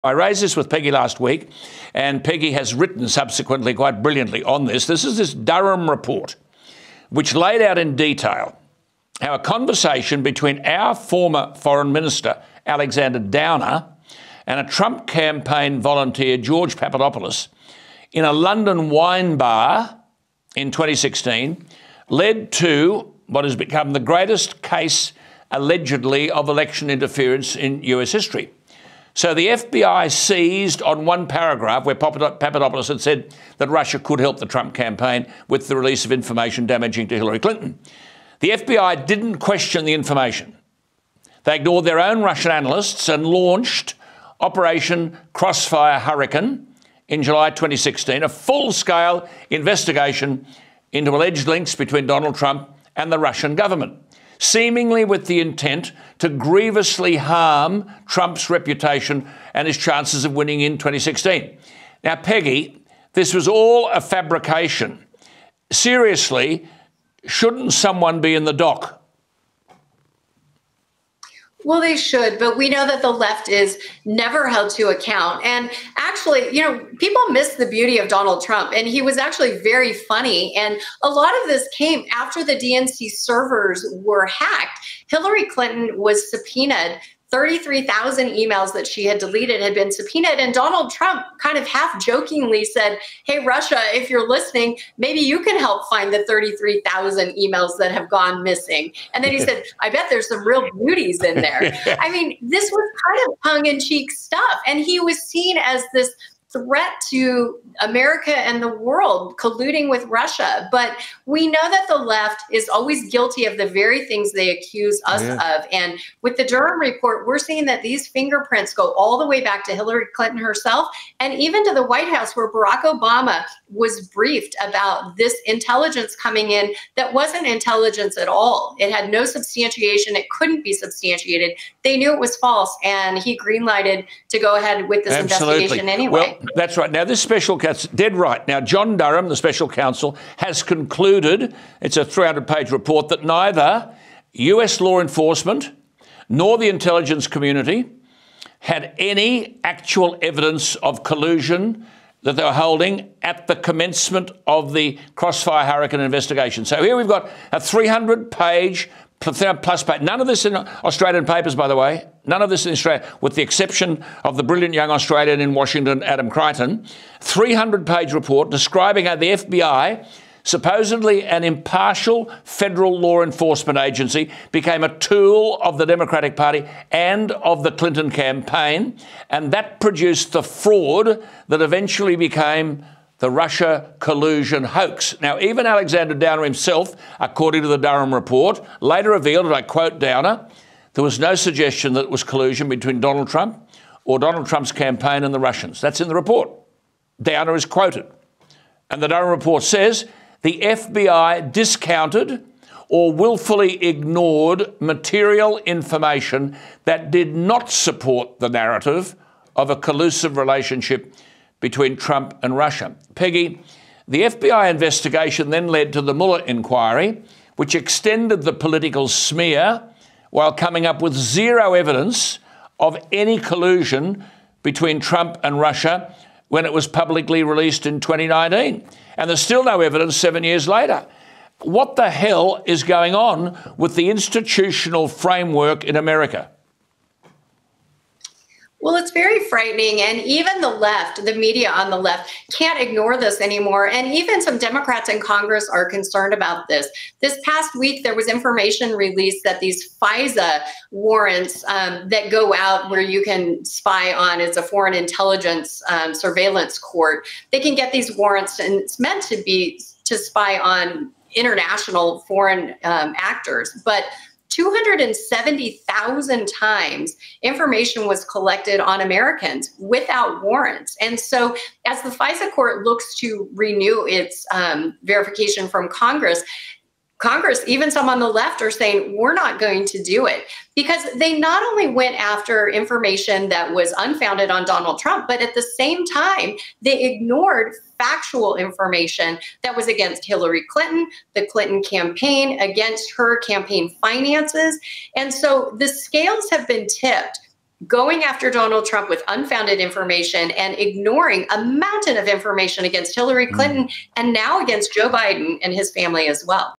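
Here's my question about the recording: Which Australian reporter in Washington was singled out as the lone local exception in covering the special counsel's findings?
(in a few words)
Adam Creighton.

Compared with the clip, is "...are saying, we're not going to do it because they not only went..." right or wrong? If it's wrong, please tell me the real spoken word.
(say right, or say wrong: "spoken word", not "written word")
right.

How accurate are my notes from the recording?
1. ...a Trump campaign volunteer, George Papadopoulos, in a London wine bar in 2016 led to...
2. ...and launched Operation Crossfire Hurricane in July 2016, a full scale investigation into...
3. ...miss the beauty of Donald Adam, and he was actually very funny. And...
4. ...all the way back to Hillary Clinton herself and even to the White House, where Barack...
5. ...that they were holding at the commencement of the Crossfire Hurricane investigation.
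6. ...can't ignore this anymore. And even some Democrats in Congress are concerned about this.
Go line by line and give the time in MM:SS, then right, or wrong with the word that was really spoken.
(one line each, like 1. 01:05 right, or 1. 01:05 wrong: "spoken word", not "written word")
1. 00:14 right
2. 00:43 right
3. 01:17 wrong: "Trump", not "Adam"
4. 01:58 right
5. 02:32 right
6. 04:02 right.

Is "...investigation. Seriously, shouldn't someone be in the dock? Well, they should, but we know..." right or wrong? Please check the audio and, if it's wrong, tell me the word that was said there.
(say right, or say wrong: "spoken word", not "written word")
wrong: "fabrication", not "investigation".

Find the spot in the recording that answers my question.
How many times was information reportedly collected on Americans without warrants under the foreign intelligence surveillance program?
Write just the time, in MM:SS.
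04:24.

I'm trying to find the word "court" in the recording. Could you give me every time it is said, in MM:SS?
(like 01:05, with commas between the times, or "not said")
04:16, 04:32.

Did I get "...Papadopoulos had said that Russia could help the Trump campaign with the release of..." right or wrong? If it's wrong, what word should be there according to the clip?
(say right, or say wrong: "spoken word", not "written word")
right.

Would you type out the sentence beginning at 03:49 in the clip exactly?
And there's still no evidence seven years later.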